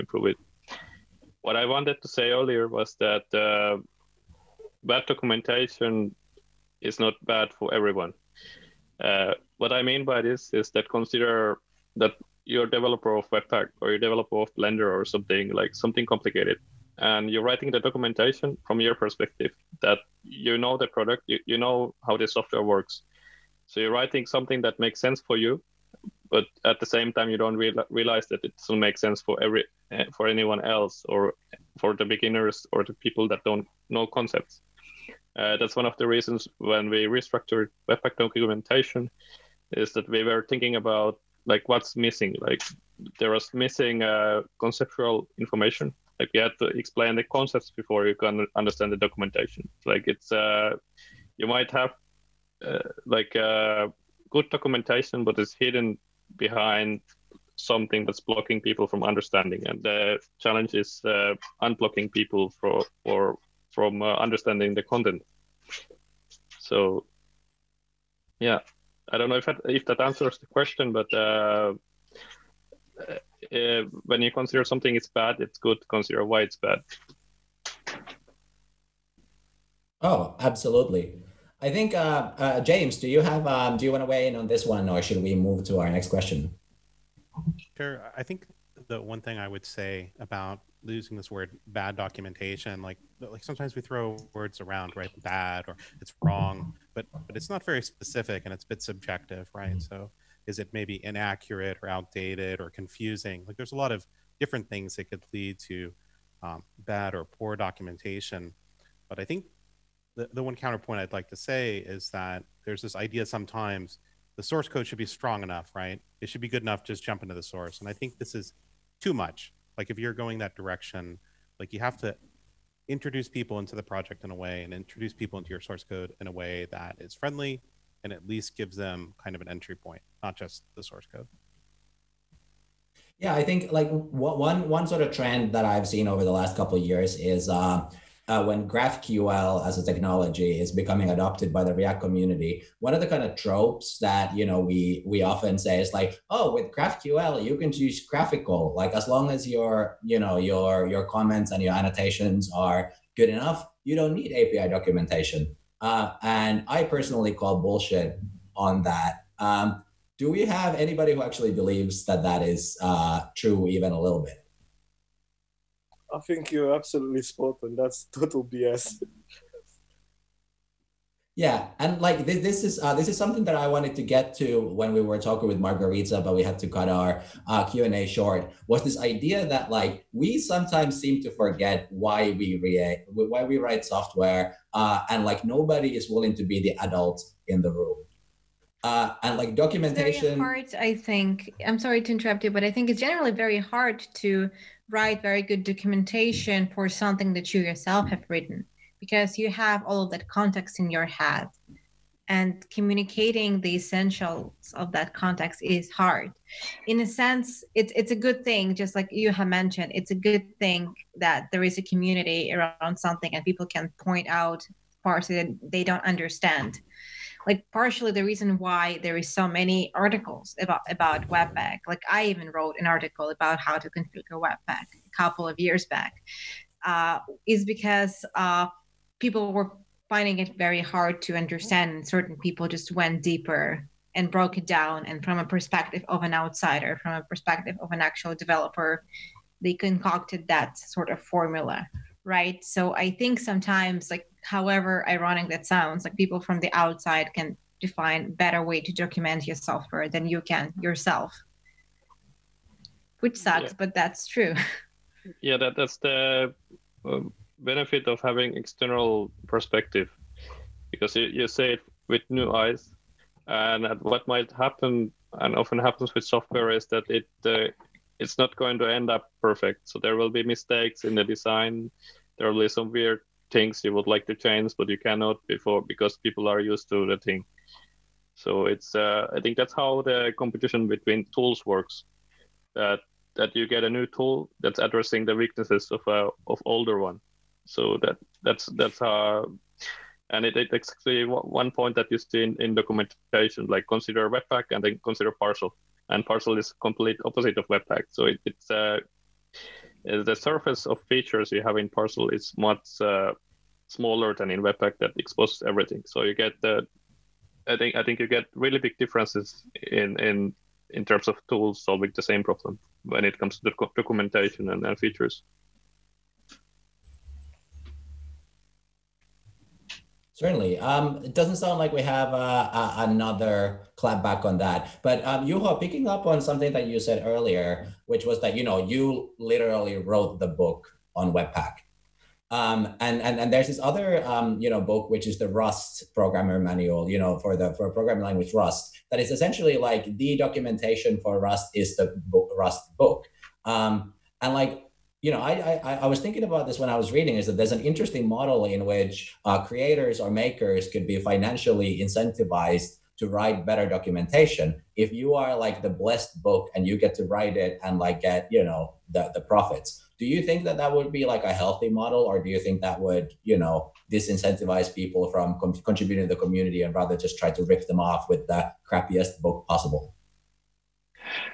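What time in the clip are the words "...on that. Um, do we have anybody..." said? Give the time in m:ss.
2:38.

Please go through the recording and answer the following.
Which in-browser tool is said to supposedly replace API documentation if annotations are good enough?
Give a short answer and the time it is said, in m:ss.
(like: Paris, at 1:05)
GraphiQL, at 2:28.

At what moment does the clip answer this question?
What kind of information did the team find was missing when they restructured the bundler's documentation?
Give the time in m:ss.
0:44.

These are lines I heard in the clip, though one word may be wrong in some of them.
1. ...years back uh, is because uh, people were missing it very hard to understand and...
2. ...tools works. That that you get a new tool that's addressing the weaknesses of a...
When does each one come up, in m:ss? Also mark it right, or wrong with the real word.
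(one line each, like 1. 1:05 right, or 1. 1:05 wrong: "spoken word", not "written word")
1. 3:45 wrong: "finding", not "missing"
2. 4:41 right.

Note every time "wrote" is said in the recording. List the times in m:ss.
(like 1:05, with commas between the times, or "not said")
3:42, 5:29.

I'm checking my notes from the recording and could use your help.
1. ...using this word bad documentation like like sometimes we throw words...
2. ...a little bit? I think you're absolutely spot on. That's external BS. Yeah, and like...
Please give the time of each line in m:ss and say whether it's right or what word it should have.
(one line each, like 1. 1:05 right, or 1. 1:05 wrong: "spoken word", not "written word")
1. 1:30 right
2. 2:43 wrong: "total", not "external".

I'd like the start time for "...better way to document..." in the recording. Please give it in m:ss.
4:08.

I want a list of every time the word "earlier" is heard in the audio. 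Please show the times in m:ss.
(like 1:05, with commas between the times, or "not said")
0:02, 5:27.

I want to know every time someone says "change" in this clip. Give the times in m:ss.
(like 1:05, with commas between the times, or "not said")
4:34.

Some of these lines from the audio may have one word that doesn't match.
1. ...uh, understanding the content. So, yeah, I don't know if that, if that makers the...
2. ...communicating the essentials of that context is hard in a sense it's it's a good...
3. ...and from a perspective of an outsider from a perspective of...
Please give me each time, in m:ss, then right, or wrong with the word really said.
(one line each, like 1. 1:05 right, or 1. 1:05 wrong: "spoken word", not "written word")
1. 1:04 wrong: "answers", not "makers"
2. 3:22 right
3. 3:55 right.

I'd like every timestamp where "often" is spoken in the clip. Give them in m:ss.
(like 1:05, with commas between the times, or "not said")
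2:25, 4:25.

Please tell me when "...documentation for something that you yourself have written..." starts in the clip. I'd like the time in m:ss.
3:15.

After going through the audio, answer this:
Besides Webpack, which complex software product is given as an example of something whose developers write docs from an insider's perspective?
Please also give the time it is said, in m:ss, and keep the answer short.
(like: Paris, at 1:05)
Blender, at 0:14.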